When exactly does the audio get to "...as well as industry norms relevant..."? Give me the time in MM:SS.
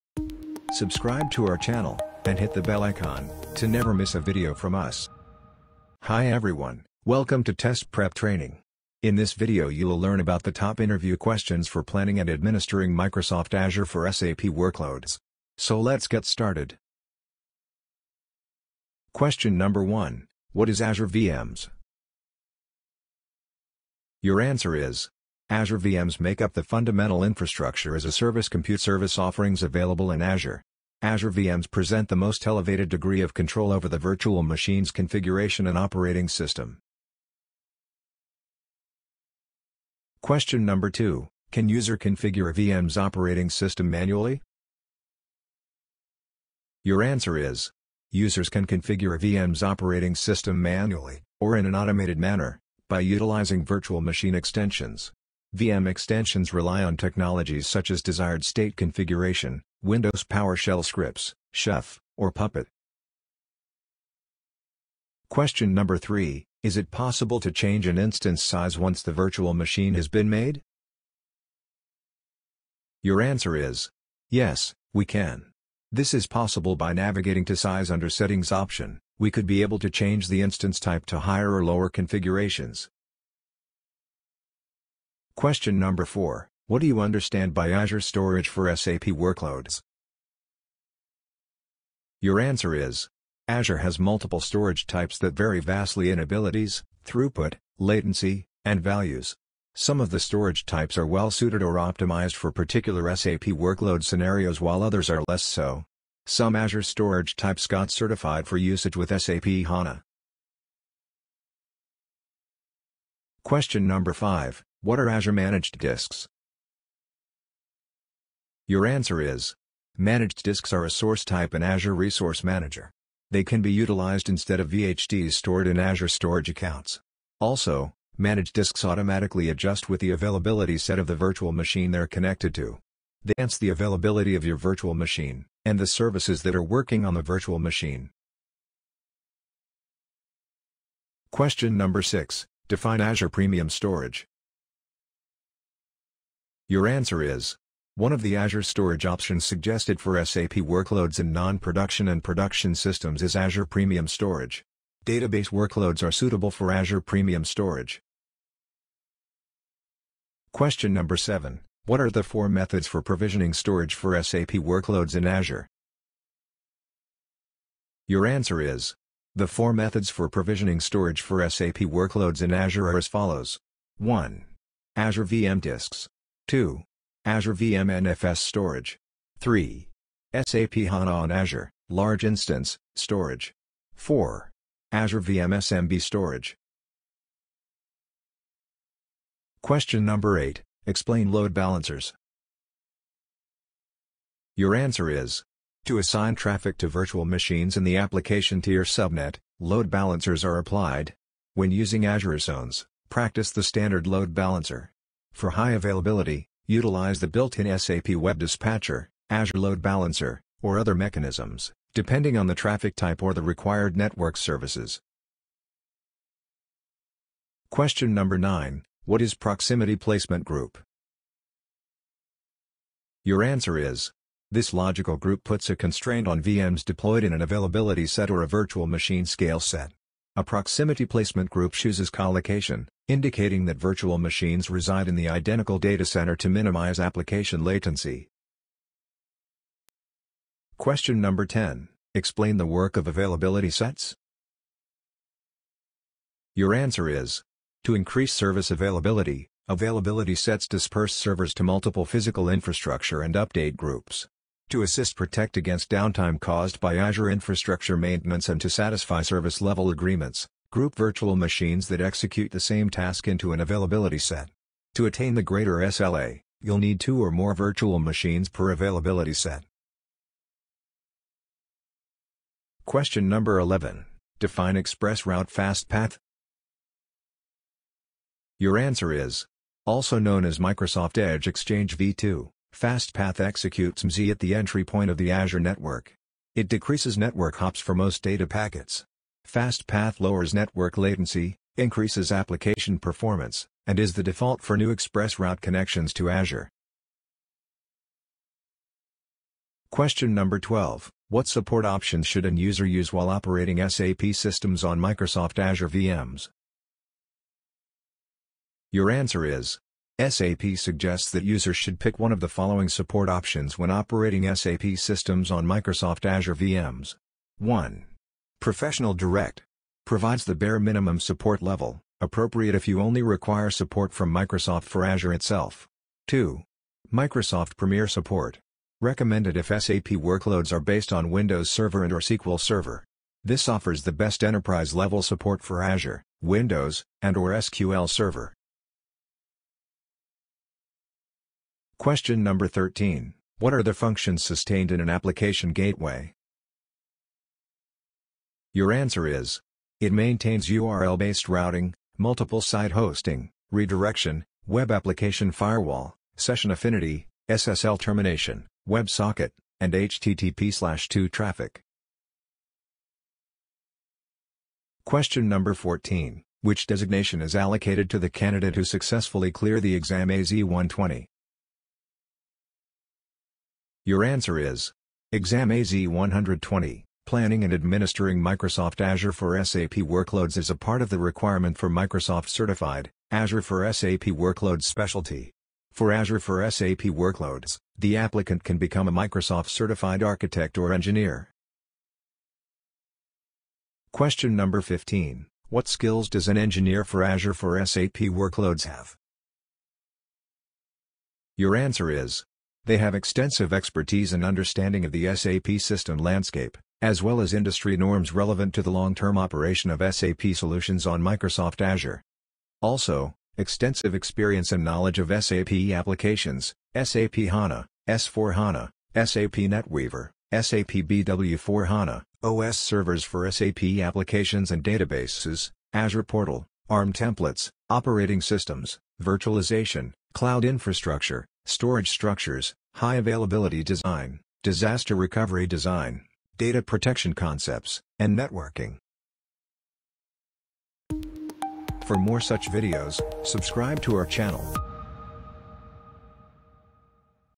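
06:47.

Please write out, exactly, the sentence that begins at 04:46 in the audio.
It decreases network hops for most data packets.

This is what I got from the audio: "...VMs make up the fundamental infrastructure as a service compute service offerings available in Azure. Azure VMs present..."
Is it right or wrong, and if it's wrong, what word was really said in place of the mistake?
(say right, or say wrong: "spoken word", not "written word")
right.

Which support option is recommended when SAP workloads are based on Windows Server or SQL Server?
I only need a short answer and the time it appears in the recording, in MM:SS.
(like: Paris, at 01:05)
Microsoft Premier Support, at 05:27.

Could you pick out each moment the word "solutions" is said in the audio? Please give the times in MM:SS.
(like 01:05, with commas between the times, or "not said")
06:50.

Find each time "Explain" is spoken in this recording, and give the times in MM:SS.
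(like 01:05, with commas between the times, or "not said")
03:10, 04:02.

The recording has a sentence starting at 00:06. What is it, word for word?
Hi everyone, welcome to Test Prep Training.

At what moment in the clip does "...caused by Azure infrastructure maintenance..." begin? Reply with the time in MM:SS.
04:16.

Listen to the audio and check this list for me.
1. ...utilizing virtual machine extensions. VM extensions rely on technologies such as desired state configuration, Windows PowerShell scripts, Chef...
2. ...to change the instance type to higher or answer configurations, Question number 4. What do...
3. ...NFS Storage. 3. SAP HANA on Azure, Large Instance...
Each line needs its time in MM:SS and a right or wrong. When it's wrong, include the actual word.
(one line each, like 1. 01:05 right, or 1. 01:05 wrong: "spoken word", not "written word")
1. 00:53 right
2. 01:19 wrong: "lower", not "answer"
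3. 02:58 right.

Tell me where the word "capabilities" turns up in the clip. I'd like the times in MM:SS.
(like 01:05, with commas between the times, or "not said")
not said.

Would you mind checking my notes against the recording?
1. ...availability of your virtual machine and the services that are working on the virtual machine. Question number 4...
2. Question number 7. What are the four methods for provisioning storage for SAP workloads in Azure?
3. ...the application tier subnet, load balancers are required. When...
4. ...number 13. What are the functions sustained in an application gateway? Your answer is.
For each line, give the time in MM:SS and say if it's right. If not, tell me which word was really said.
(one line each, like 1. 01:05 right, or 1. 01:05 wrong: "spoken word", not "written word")
1. 02:13 wrong: "6", not "4"
2. 02:40 right
3. 03:17 wrong: "applied", not "required"
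4. 05:42 right.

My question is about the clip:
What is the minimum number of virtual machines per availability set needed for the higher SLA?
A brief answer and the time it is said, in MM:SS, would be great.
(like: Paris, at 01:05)
2, at 04:27.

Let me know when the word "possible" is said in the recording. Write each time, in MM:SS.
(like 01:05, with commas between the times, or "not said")
01:06, 01:16.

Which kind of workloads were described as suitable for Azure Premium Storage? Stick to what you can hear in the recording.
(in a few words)
Database workloads.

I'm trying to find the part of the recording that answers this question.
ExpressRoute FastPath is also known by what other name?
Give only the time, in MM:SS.
04:40.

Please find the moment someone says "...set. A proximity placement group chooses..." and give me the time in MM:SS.
03:49.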